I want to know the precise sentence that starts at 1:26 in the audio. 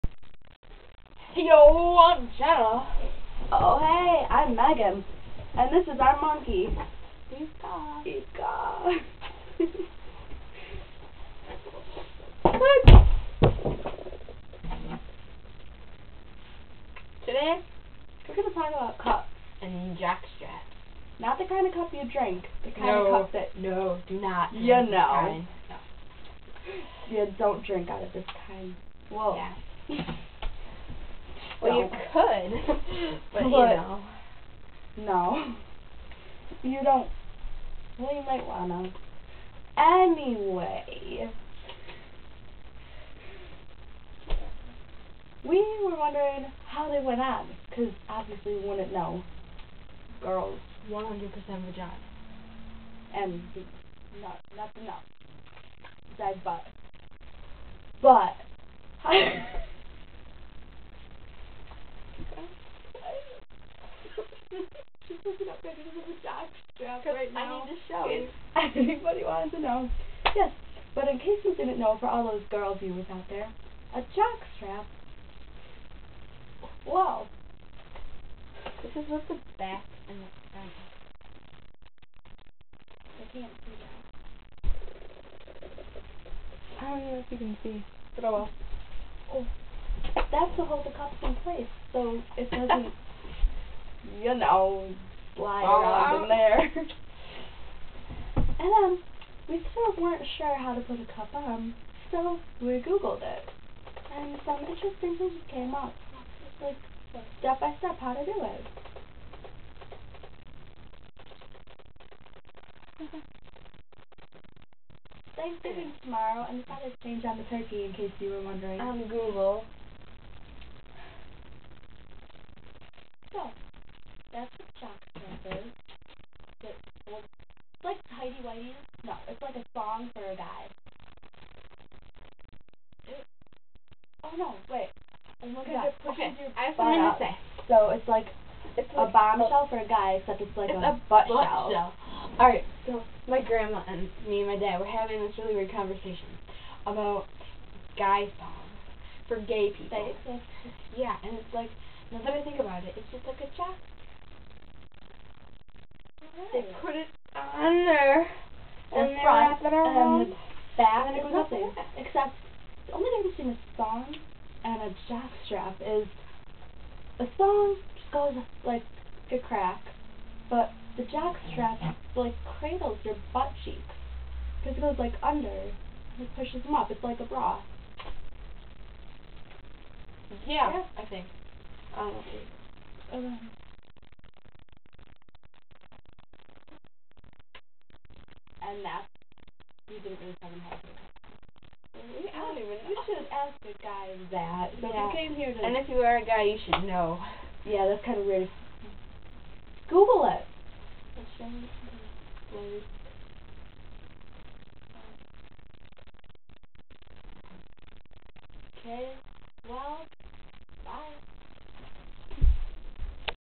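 I don't know if you can see, but oh well.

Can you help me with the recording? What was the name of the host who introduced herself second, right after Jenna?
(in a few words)
Megan.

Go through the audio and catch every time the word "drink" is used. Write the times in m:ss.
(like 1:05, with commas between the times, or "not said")
0:22, 0:27.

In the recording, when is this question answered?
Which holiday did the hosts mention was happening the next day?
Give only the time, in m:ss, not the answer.
1:55.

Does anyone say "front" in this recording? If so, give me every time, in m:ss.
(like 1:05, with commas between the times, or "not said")
1:20.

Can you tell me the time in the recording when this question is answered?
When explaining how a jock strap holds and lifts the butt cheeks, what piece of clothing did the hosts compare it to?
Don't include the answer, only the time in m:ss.
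2:57.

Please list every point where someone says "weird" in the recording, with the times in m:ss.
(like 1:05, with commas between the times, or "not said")
2:25, 3:18.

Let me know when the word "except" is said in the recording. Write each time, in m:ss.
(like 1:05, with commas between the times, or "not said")
2:20, 2:41.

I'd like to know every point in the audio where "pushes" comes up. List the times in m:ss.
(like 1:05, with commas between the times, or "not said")
2:56.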